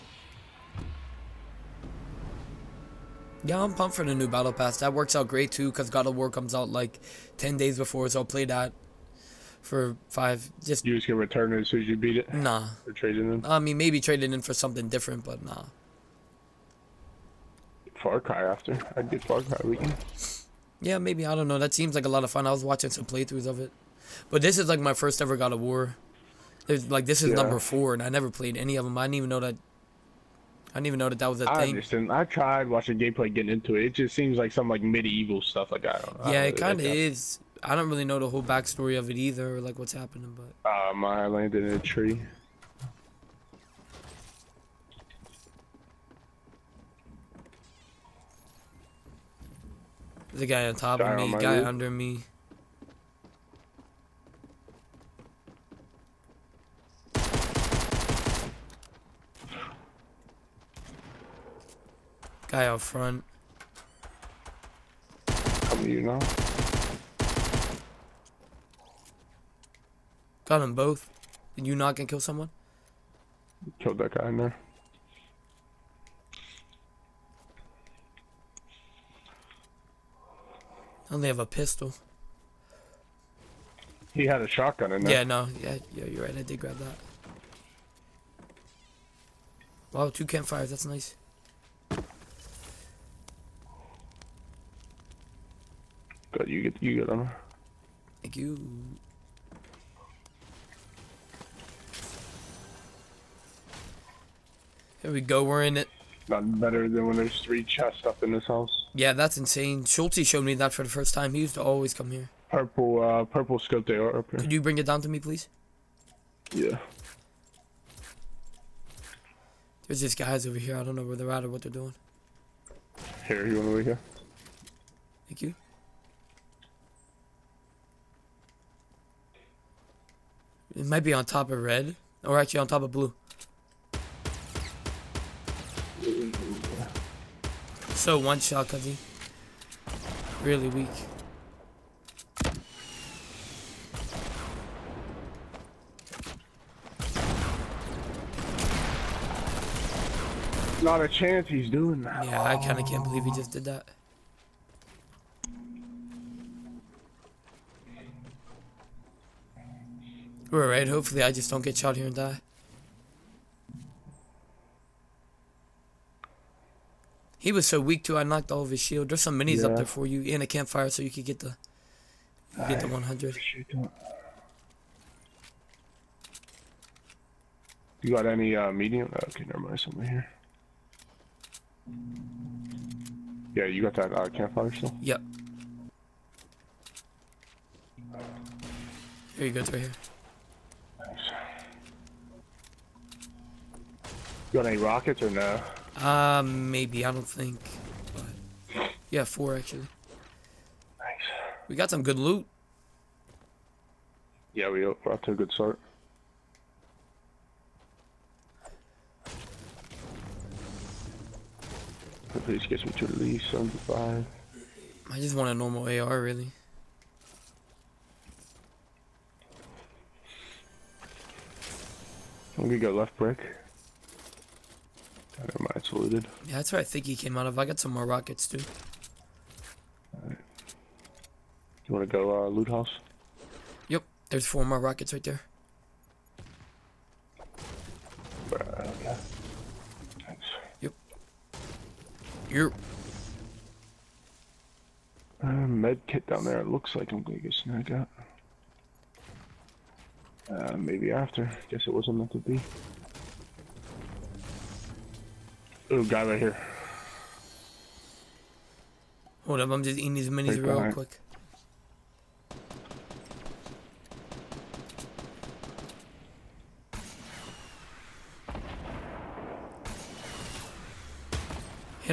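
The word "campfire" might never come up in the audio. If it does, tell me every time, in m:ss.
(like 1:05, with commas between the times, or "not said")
1:30, 2:50, 3:04.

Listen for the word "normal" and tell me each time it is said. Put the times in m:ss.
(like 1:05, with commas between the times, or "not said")
3:35.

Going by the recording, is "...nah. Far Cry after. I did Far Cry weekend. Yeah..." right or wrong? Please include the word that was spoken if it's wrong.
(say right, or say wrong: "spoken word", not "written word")
right.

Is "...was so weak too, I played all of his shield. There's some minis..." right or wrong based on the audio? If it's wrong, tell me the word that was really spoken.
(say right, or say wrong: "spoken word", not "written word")
wrong: "knocked", not "played".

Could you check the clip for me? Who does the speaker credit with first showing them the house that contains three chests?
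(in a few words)
Schulte.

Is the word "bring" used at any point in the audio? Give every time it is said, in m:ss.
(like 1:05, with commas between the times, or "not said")
1:54.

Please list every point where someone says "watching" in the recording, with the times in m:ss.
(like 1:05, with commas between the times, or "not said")
0:22, 0:32.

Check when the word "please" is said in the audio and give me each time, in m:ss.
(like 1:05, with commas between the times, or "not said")
1:55, 3:32.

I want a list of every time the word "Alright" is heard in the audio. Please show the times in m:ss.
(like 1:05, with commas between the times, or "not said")
2:40, 3:50.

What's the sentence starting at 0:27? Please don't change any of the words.
number four, and I never played any of them.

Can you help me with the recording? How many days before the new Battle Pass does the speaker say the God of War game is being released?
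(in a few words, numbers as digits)
10.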